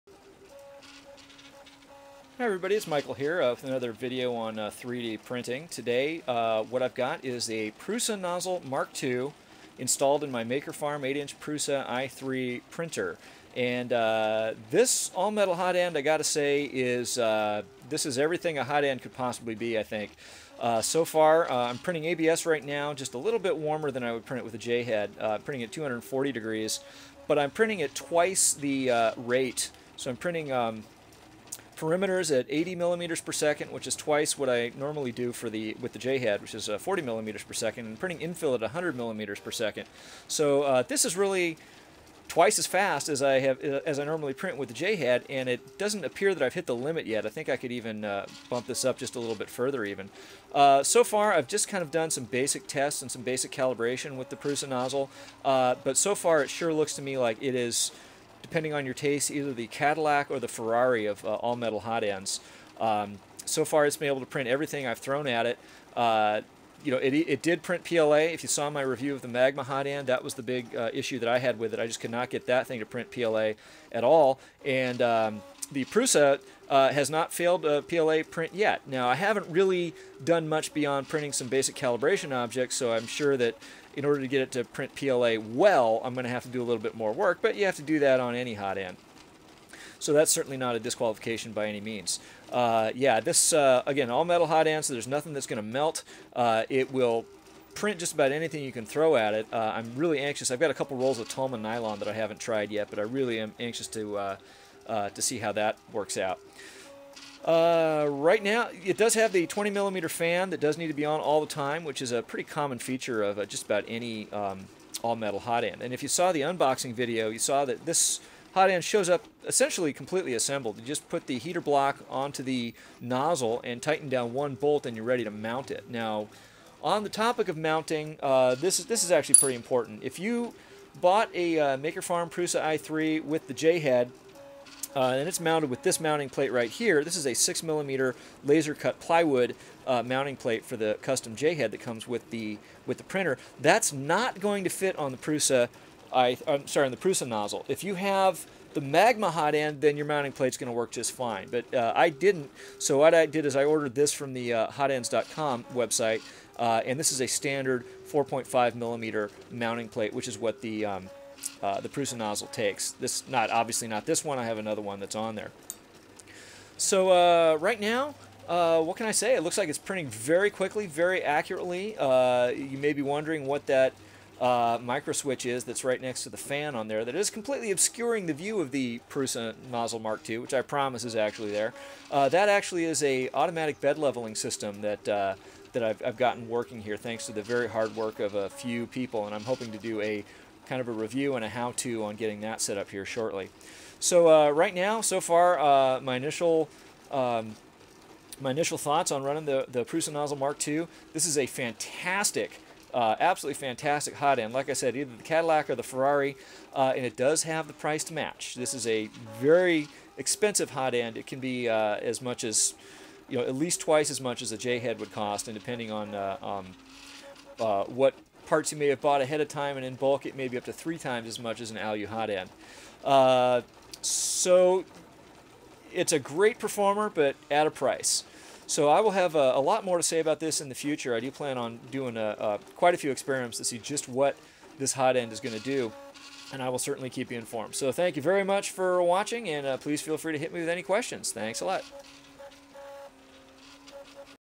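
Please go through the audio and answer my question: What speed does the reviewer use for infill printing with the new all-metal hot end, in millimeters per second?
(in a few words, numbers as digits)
100 millimeters per second.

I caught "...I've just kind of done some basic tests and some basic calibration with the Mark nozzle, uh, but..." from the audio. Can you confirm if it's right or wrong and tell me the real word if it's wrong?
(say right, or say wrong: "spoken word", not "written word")
wrong: "Prusa", not "Mark".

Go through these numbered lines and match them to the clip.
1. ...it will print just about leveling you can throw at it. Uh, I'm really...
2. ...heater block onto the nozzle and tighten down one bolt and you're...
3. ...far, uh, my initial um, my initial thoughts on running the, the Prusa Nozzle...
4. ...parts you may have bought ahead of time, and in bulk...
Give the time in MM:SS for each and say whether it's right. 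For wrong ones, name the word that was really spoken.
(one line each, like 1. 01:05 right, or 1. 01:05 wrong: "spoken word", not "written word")
1. 01:36 wrong: "anything", not "leveling"
2. 02:01 right
3. 03:15 right
4. 03:38 right.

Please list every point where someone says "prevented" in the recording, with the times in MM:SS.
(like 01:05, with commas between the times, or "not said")
not said.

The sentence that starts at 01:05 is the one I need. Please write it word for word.
Uh, you know, it, it did print PLA.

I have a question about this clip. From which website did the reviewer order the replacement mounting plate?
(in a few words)
hotends.com.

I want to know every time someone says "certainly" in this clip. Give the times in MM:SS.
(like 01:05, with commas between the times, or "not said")
01:30, 03:56.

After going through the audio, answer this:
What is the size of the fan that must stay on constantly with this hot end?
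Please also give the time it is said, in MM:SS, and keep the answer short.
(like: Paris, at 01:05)
20 millimeter, at 01:49.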